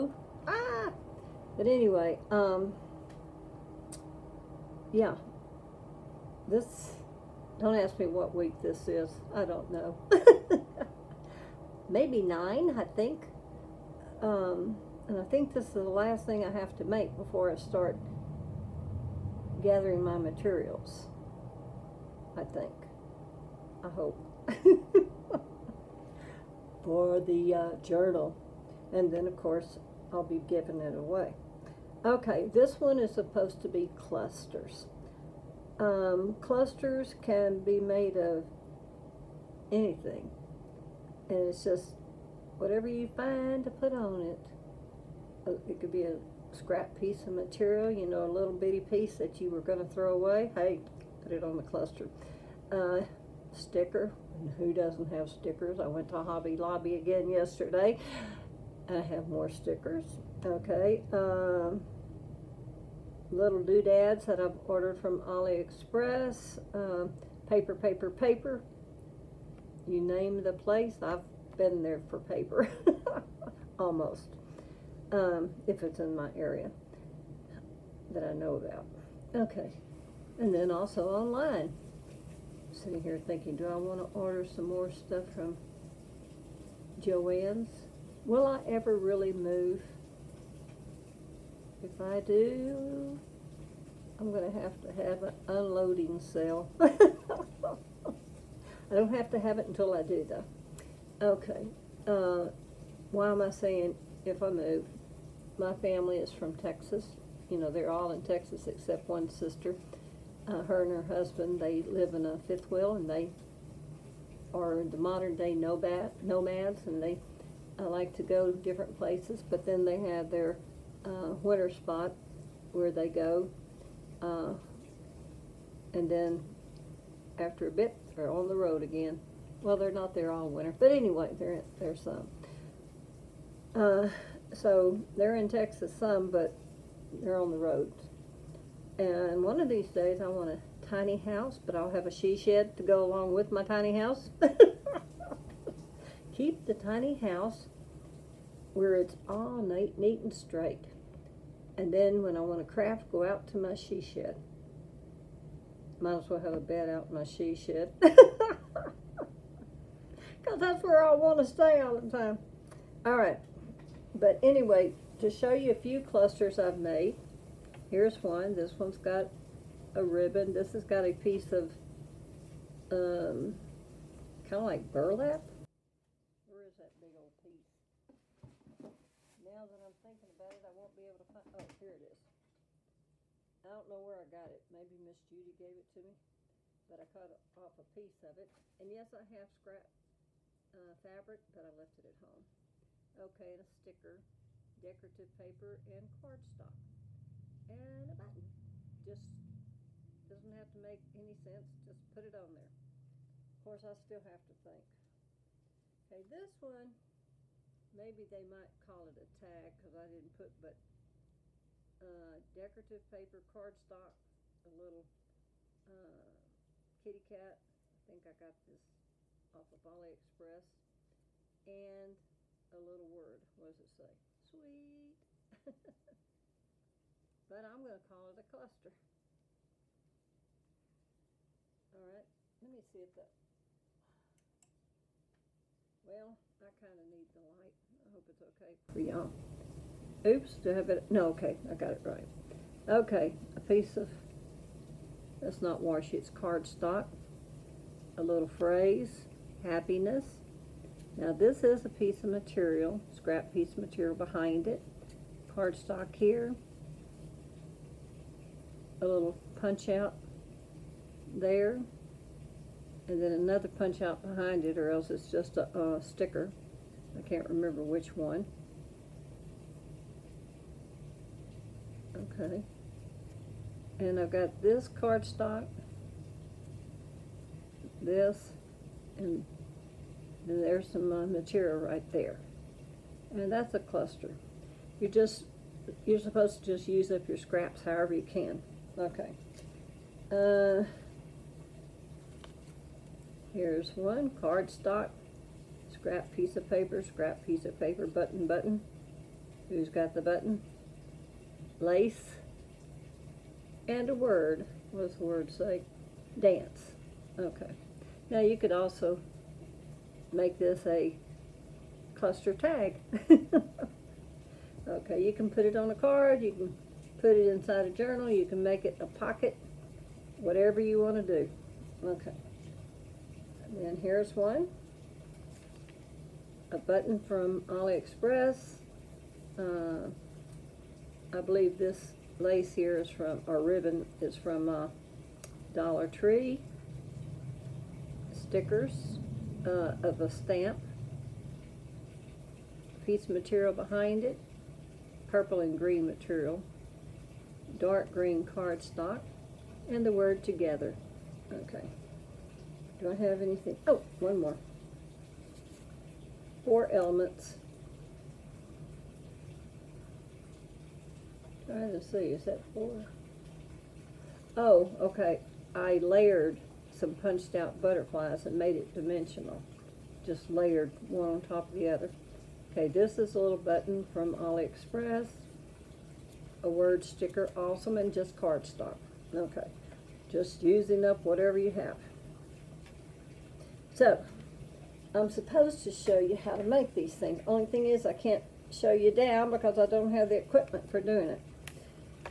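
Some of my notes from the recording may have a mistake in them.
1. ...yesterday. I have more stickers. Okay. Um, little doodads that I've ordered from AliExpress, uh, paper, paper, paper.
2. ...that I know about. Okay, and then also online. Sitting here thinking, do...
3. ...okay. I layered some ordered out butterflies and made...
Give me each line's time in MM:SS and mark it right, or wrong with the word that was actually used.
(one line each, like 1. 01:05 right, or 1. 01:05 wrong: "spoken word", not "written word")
1. 00:57 right
2. 01:18 right
3. 06:04 wrong: "punched", not "ordered".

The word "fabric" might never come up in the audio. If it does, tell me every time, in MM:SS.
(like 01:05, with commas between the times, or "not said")
03:11.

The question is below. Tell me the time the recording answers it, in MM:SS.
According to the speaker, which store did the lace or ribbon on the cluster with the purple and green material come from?
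05:35.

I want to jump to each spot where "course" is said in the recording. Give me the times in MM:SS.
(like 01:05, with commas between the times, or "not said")
00:29, 03:23.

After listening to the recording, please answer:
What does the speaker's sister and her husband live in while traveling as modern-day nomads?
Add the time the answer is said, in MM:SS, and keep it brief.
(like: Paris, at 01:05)
A fifth wheel, at 01:52.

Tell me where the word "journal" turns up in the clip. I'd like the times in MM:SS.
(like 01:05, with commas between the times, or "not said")
00:27, 05:17.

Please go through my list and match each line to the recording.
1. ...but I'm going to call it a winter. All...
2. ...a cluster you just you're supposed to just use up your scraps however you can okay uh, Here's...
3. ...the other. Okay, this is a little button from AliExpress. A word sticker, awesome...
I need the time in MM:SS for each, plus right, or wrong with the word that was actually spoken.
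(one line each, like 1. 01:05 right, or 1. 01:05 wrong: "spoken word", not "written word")
1. 03:47 wrong: "cluster", not "winter"
2. 04:43 right
3. 06:11 right.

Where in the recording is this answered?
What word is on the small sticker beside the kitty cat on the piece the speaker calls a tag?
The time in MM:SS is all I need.
03:44.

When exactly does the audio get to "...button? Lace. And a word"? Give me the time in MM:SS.
05:00.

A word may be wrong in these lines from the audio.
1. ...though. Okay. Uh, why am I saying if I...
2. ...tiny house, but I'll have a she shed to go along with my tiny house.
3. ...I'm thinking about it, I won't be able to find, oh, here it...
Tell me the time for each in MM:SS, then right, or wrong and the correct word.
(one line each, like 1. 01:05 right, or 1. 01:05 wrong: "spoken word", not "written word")
1. 01:40 right
2. 02:20 right
3. 02:59 right.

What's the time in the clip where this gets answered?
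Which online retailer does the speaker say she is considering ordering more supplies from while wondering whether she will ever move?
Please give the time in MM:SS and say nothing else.
01:27.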